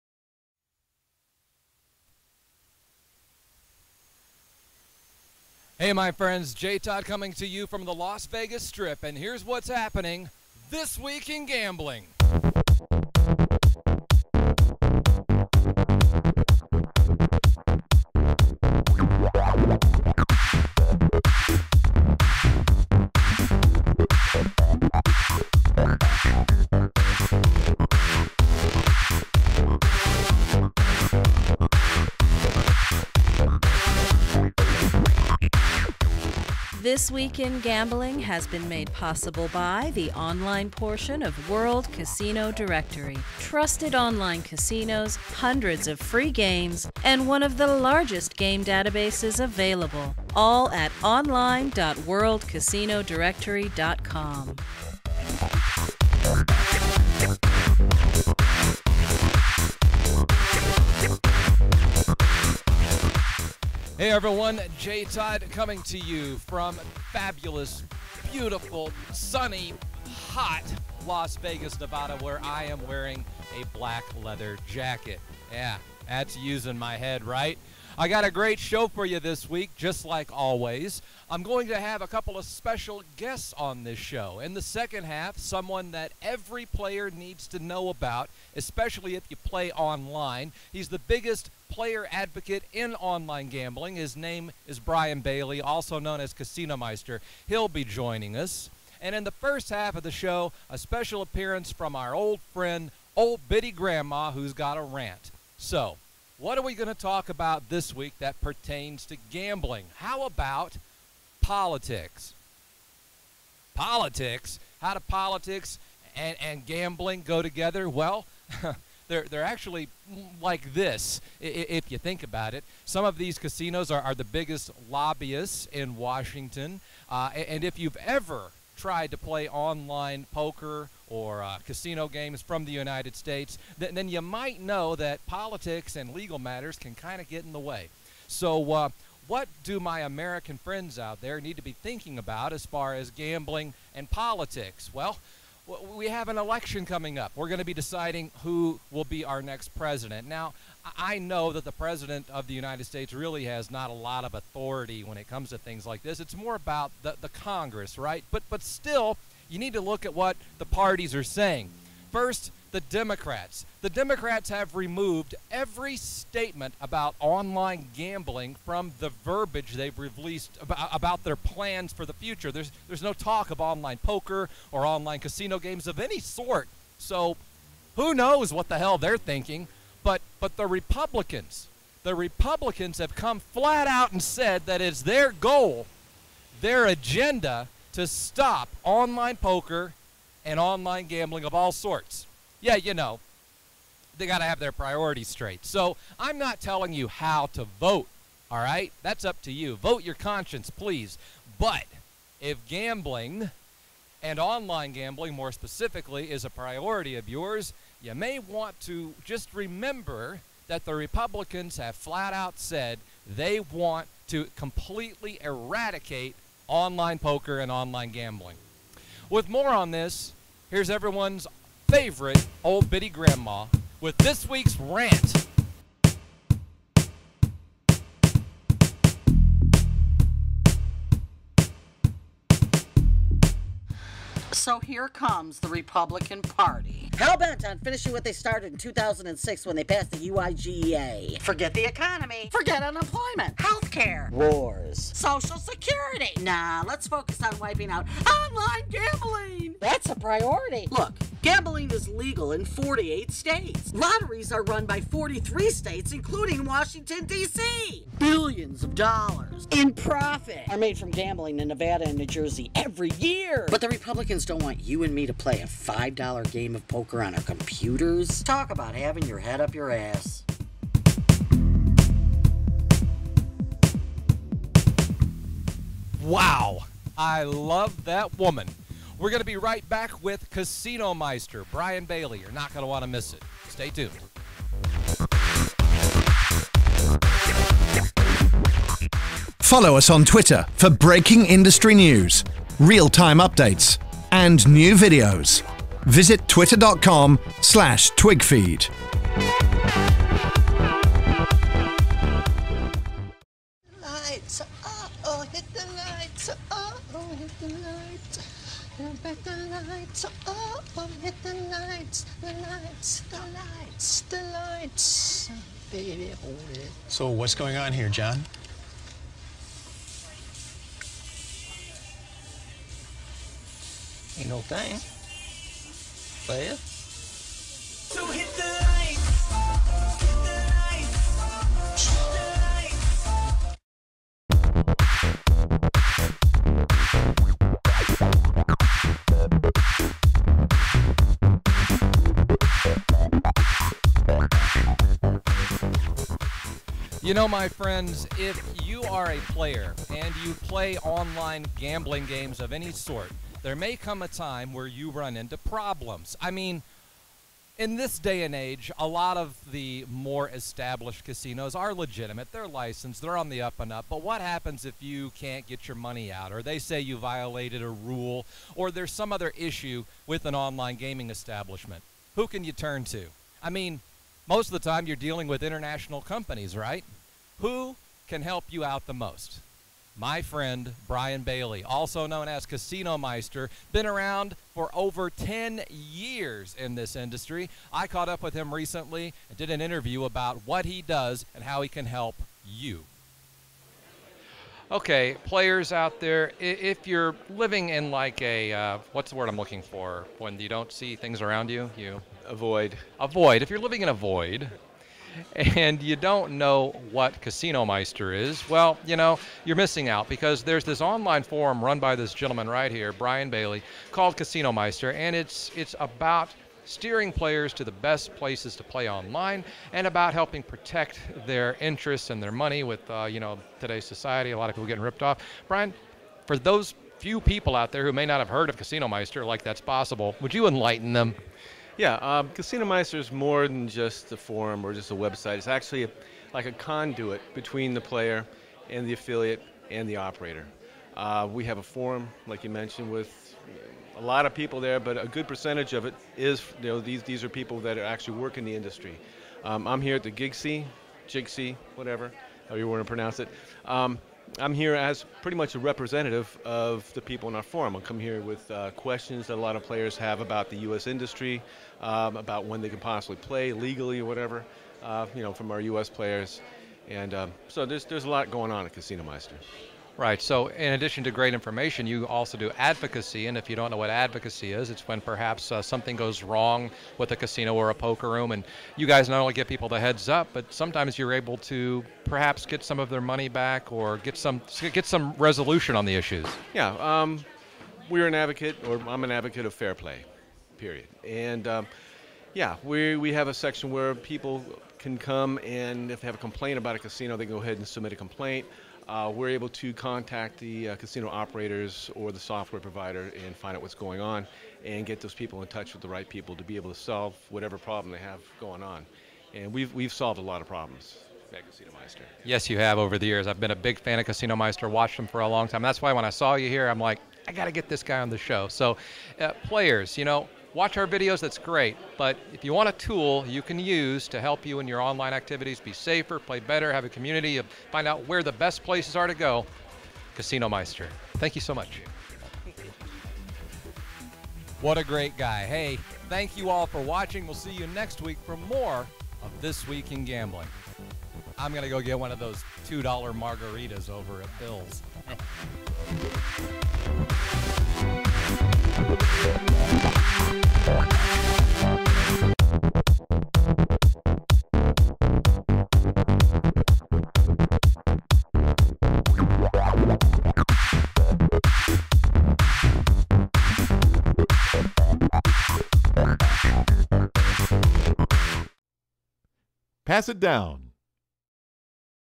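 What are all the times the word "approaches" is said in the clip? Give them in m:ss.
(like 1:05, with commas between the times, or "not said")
not said.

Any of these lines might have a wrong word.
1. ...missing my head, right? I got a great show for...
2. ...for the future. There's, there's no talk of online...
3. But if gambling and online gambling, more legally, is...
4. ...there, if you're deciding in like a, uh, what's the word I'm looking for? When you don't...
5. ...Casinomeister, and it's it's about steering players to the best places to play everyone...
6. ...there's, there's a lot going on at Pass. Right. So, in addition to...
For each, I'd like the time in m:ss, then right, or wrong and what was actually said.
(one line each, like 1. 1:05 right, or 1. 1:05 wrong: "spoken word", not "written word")
1. 1:16 wrong: "using", not "missing"
2. 2:51 right
3. 3:21 wrong: "specifically", not "legally"
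4. 6:36 wrong: "living", not "deciding"
5. 6:54 wrong: "online", not "everyone"
6. 7:47 wrong: "Casinomeister", not "Pass".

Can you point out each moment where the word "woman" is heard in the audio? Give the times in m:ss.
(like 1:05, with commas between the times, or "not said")
4:38.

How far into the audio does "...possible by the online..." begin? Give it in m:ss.
0:38.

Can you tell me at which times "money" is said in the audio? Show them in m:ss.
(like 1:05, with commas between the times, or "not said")
6:05, 7:02, 8:03.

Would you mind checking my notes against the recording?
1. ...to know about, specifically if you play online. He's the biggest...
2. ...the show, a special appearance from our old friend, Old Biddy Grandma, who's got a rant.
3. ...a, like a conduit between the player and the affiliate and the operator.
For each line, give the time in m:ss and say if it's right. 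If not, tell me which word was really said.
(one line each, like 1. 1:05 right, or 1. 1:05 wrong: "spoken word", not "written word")
1. 1:27 wrong: "especially", not "specifically"
2. 1:40 right
3. 7:16 right.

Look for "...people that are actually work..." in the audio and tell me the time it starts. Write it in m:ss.
7:27.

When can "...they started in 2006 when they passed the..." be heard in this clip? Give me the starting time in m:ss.
3:58.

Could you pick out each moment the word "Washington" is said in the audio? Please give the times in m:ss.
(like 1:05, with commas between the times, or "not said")
2:05, 4:16.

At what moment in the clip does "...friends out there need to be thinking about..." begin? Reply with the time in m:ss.
2:20.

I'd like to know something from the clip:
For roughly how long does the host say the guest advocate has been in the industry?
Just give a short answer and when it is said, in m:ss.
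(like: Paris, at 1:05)
over 10 years, at 6:24.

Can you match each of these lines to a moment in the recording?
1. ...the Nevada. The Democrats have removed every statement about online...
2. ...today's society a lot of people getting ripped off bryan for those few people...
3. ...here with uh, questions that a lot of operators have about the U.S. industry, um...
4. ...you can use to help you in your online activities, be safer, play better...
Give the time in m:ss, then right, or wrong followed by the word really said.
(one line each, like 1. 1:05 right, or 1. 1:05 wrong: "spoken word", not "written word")
1. 2:42 wrong: "Democrats", not "Nevada"
2. 7:03 right
3. 7:38 wrong: "players", not "operators"
4. 8:43 right.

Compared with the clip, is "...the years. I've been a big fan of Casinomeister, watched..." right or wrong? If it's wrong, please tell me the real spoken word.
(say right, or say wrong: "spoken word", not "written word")
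right.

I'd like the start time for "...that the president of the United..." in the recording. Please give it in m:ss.
2:31.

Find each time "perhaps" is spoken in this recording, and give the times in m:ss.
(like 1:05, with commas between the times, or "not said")
7:55, 8:02.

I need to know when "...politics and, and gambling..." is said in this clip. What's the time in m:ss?
1:55.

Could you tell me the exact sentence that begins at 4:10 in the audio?
Look, Gambling is legal in 48 states.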